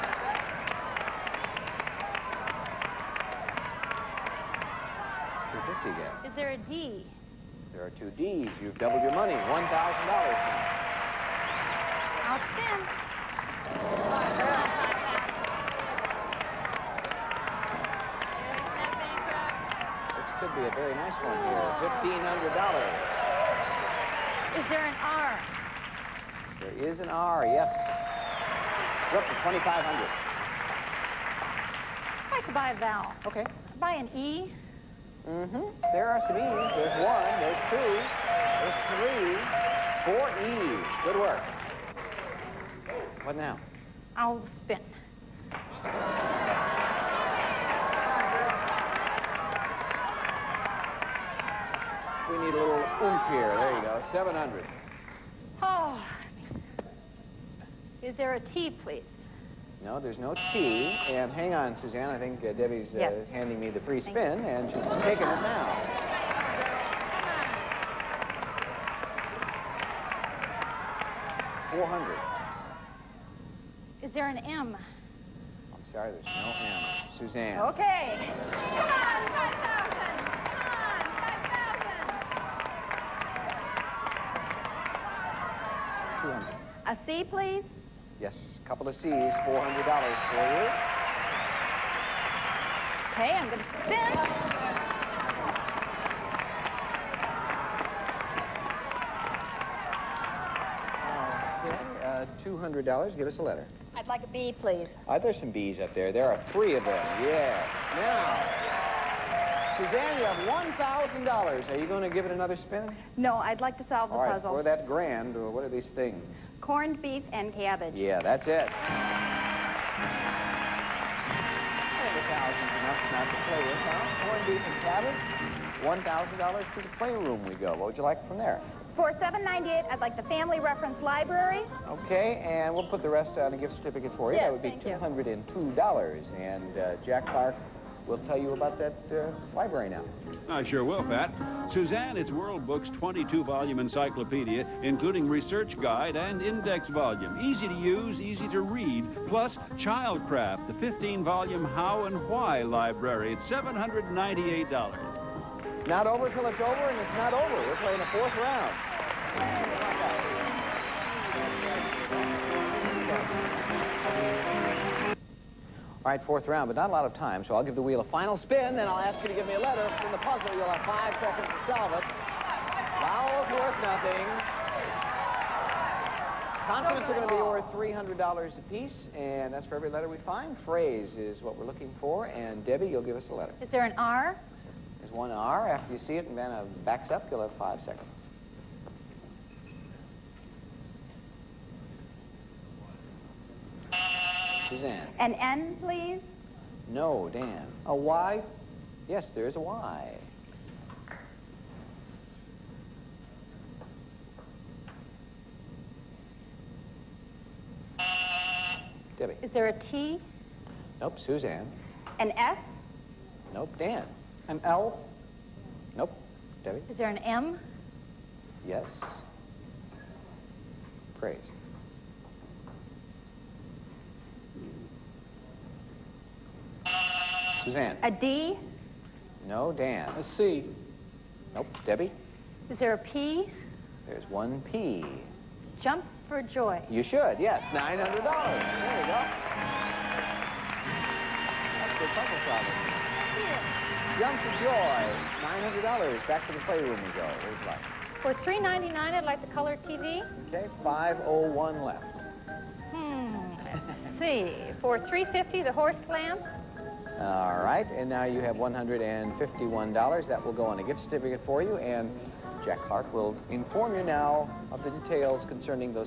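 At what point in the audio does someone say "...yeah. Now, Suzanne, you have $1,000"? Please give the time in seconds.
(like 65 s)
107 s.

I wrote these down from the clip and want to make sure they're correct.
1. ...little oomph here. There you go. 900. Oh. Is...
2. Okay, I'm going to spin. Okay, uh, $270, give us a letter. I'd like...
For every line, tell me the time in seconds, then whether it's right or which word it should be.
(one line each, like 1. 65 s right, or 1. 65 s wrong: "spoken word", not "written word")
1. 52 s wrong: "700", not "900"
2. 93 s wrong: "200", not "270".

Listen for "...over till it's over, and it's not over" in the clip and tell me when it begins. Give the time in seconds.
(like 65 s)
156 s.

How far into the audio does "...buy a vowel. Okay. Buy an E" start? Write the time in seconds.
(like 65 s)
32 s.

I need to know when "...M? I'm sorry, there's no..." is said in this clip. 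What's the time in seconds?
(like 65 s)
74 s.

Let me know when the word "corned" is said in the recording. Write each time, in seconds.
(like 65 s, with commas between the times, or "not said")
116 s, 124 s.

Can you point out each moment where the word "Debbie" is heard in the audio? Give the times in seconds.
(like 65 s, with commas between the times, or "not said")
62 s, 182 s, 209 s, 216 s, 231 s.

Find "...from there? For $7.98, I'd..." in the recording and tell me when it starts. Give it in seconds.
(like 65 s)
128 s.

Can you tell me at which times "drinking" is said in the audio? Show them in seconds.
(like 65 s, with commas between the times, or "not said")
not said.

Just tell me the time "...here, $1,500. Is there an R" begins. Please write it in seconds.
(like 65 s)
21 s.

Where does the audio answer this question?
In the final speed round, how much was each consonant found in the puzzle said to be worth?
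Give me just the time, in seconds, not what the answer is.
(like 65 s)
178 s.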